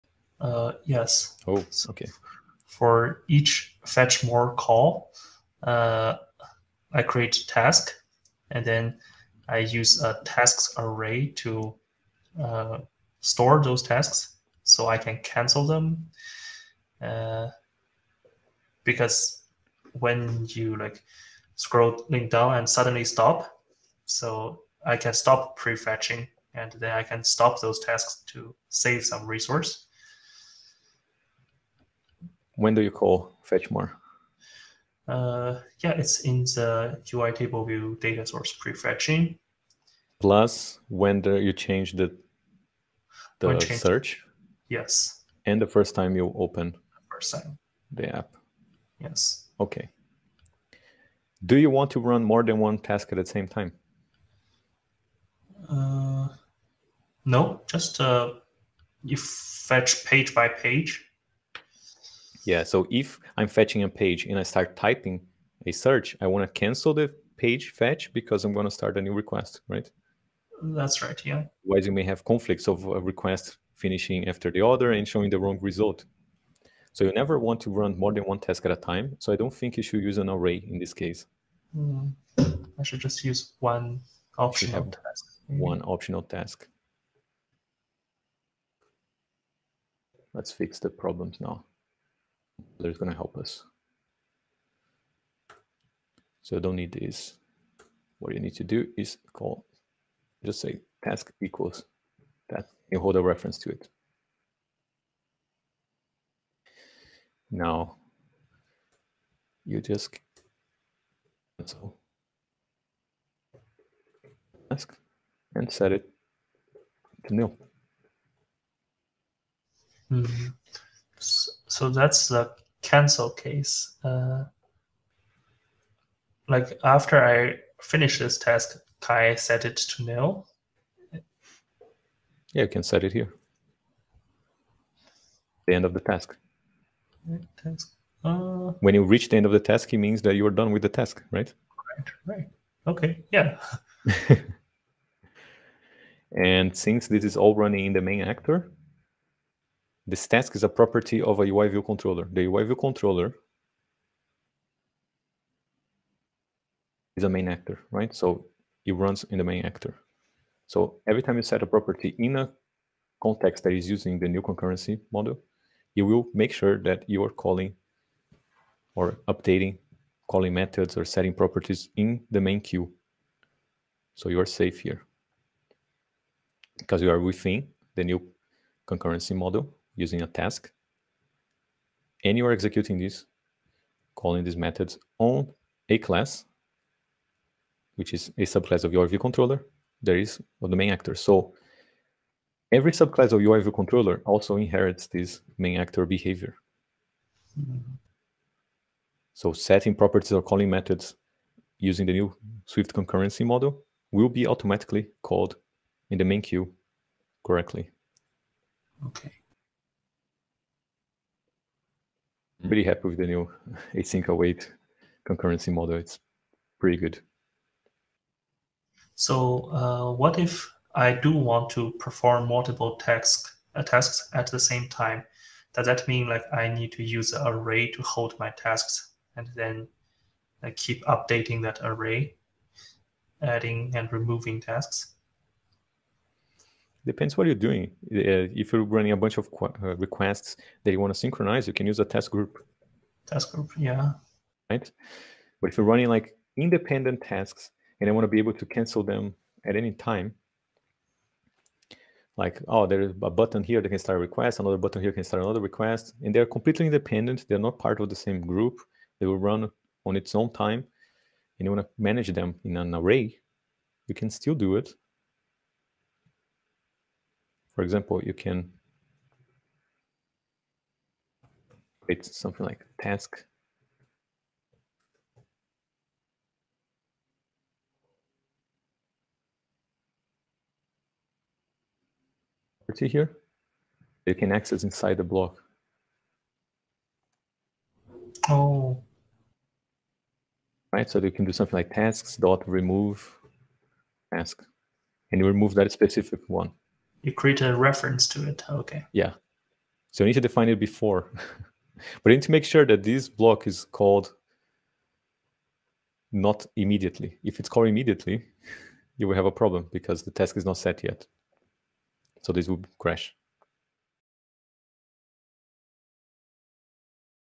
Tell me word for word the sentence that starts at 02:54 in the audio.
So you are safe here because you are within the new concurrency model using a task.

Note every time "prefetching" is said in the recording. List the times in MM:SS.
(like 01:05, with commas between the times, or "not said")
00:25, 00:38.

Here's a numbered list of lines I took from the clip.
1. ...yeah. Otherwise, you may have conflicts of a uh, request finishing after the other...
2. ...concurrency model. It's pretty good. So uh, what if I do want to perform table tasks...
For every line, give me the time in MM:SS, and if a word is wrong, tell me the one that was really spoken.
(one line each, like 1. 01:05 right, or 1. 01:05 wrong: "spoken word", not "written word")
1. 01:11 right
2. 03:35 wrong: "multiple", not "table".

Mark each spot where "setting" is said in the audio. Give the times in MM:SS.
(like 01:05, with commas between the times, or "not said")
02:51, 03:19.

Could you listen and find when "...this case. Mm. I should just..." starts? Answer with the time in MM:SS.
01:20.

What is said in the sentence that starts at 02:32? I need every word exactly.
The UI view controller is a main actor, right?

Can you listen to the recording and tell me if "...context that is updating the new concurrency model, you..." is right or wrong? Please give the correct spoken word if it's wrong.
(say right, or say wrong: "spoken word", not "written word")
wrong: "using", not "updating".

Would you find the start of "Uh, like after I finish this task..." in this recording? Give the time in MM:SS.
02:04.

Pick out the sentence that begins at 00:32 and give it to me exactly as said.
When do you call fetch more?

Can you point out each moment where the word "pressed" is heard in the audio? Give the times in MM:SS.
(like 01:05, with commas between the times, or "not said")
not said.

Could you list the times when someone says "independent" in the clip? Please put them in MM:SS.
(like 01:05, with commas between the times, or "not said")
04:06, 04:16.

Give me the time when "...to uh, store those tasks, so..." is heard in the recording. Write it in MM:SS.
00:11.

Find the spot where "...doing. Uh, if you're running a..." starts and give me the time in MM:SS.
03:57.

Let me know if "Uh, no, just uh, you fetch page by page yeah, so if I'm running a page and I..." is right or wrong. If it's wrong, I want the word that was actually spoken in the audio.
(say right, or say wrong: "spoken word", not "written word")
wrong: "fetching", not "running".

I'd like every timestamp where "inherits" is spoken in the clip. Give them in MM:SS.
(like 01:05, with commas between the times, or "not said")
03:14.